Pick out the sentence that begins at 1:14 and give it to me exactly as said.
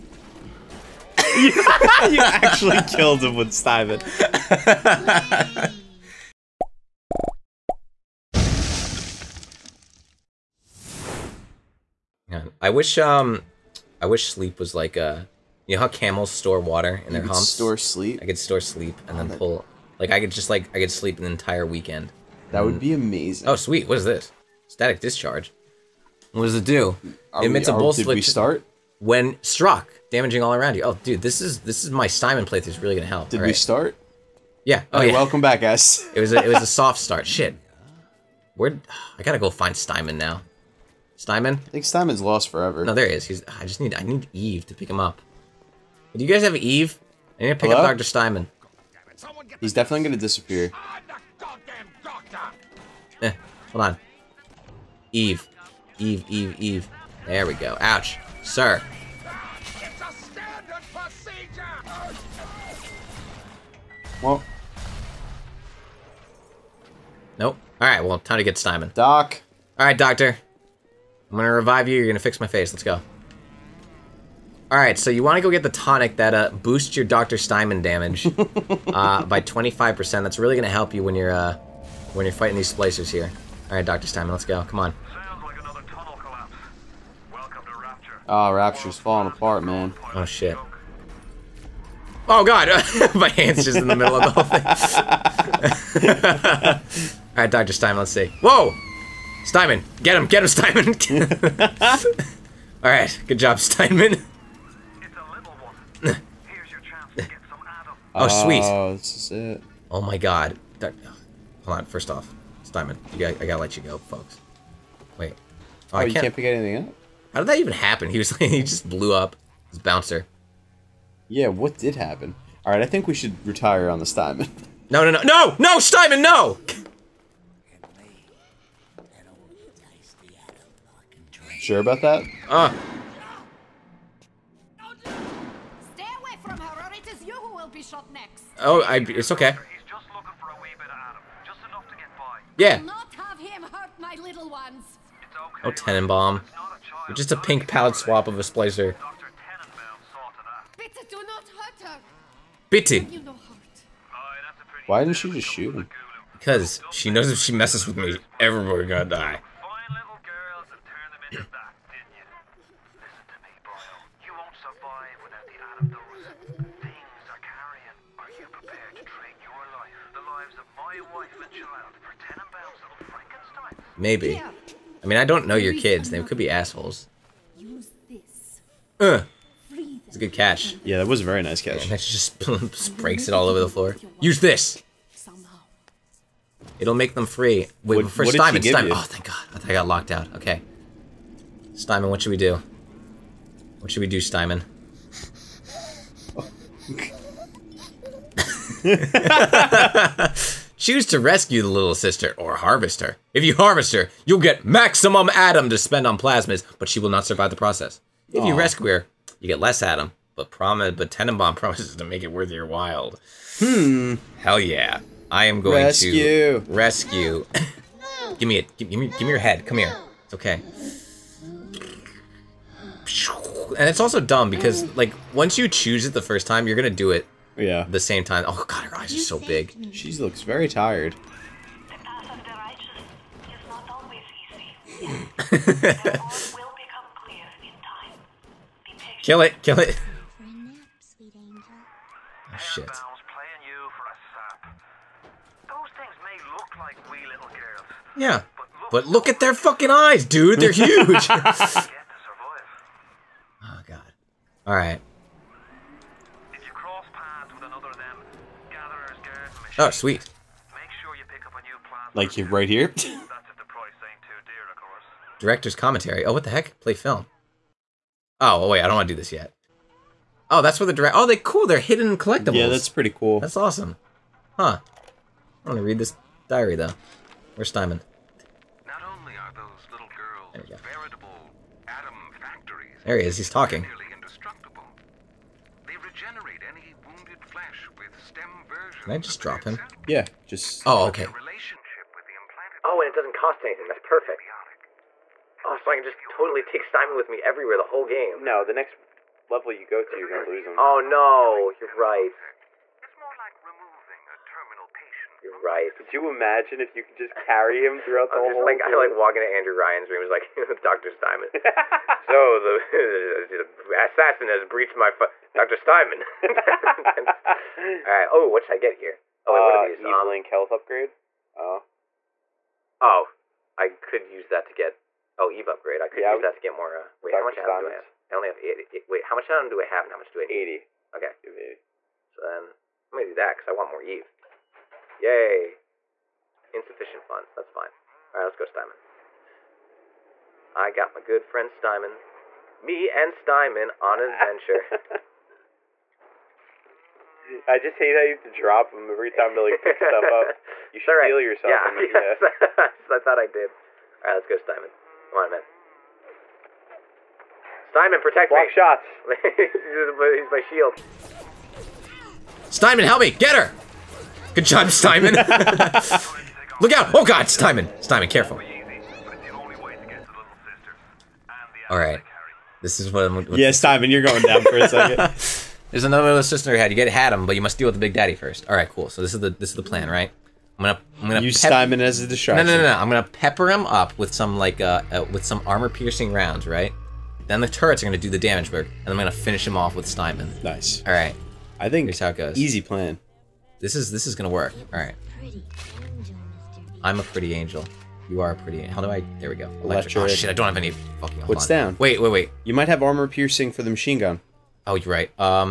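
Alright, so you want to go get the tonic that uh, boosts your Dr.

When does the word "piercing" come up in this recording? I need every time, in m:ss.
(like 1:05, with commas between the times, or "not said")
6:25, 6:43.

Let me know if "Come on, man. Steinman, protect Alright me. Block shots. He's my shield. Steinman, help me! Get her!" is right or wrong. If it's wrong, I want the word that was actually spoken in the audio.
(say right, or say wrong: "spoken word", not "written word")
wrong: "Block", not "Alright".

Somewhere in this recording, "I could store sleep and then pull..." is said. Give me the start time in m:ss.
0:18.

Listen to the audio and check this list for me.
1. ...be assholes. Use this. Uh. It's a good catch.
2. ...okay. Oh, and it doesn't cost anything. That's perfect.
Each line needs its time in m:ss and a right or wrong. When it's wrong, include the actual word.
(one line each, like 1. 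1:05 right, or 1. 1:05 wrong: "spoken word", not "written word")
1. 2:56 right
2. 4:51 right.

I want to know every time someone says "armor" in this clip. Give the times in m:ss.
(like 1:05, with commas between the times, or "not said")
6:25, 6:43.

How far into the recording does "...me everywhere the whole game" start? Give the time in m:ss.
4:57.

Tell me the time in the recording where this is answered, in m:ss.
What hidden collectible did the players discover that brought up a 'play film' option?
4:25.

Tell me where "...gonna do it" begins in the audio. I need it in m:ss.
3:46.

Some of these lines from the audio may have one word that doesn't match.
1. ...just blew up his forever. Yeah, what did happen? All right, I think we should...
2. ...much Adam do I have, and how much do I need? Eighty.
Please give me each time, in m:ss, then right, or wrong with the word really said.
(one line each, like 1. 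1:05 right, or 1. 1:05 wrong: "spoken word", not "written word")
1. 1:58 wrong: "bouncer", not "forever"
2. 5:29 right.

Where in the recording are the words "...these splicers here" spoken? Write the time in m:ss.
1:22.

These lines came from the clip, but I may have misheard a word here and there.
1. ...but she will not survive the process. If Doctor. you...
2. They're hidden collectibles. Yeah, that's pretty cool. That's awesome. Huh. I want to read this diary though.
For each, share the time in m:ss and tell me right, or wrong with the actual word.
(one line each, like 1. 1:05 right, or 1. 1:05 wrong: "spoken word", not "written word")
1. 3:26 wrong: "Aww", not "Doctor"
2. 4:31 right.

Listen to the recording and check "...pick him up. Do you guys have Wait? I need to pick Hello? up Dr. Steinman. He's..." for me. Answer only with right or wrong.
wrong.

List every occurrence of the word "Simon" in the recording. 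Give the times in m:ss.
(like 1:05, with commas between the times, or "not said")
0:32, 5:27.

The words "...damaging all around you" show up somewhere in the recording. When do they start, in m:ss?
0:30.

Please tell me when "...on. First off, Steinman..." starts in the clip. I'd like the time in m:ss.
1:51.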